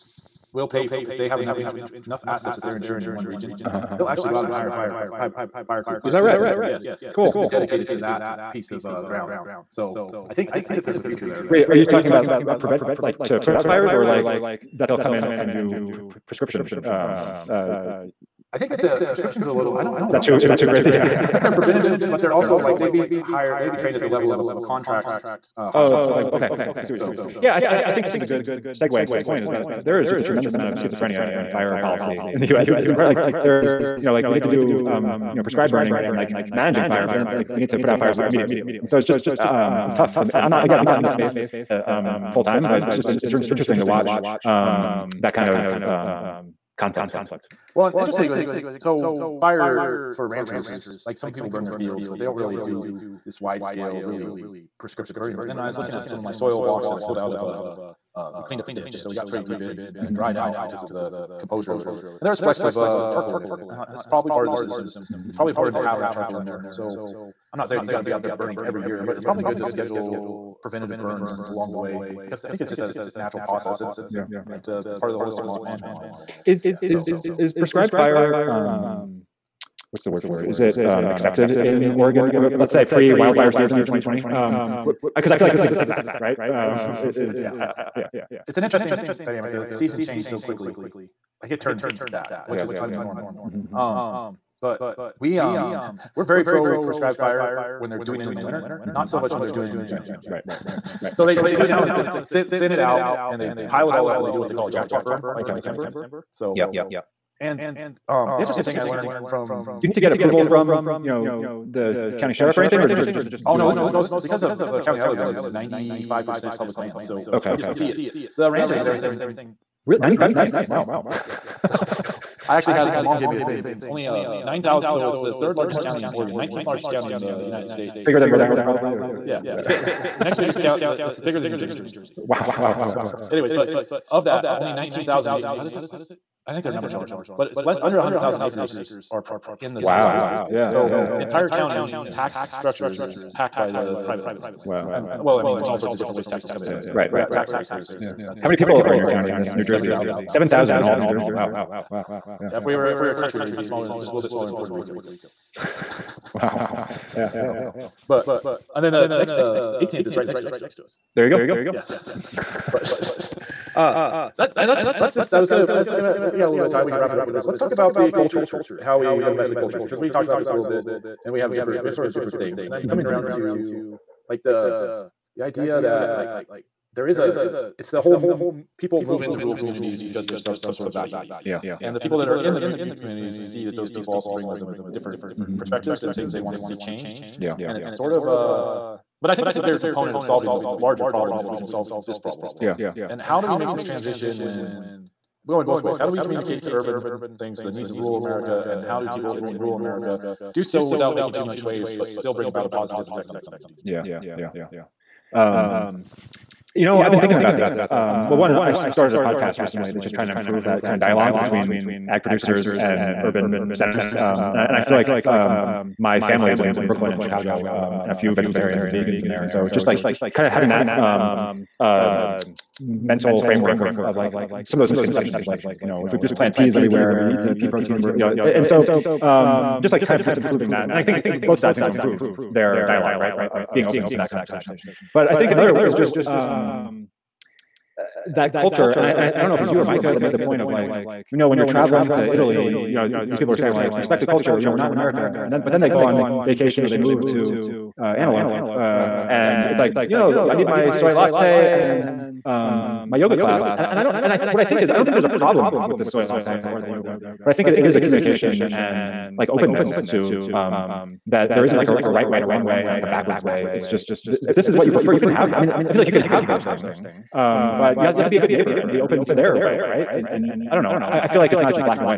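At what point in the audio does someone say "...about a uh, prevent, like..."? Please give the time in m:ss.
0:12.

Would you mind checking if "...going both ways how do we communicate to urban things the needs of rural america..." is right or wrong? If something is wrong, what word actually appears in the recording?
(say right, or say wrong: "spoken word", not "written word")
right.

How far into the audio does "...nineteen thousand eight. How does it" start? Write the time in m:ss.
2:14.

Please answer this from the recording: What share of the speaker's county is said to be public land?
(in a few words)
95 percent.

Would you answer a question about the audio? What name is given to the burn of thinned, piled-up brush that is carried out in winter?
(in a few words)
jackpot burn.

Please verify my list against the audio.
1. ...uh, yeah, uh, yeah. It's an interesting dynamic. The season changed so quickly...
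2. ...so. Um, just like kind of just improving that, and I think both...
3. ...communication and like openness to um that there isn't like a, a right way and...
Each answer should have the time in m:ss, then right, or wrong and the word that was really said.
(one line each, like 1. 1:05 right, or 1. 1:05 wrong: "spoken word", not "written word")
1. 1:27 right
2. 3:48 right
3. 4:17 right.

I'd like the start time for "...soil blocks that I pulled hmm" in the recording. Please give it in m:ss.
0:56.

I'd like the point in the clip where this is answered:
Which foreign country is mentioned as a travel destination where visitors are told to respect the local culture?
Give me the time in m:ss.
4:02.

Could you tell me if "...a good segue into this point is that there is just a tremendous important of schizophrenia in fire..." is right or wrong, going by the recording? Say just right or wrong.
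wrong.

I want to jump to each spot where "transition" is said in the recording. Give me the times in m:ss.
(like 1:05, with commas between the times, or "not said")
3:13.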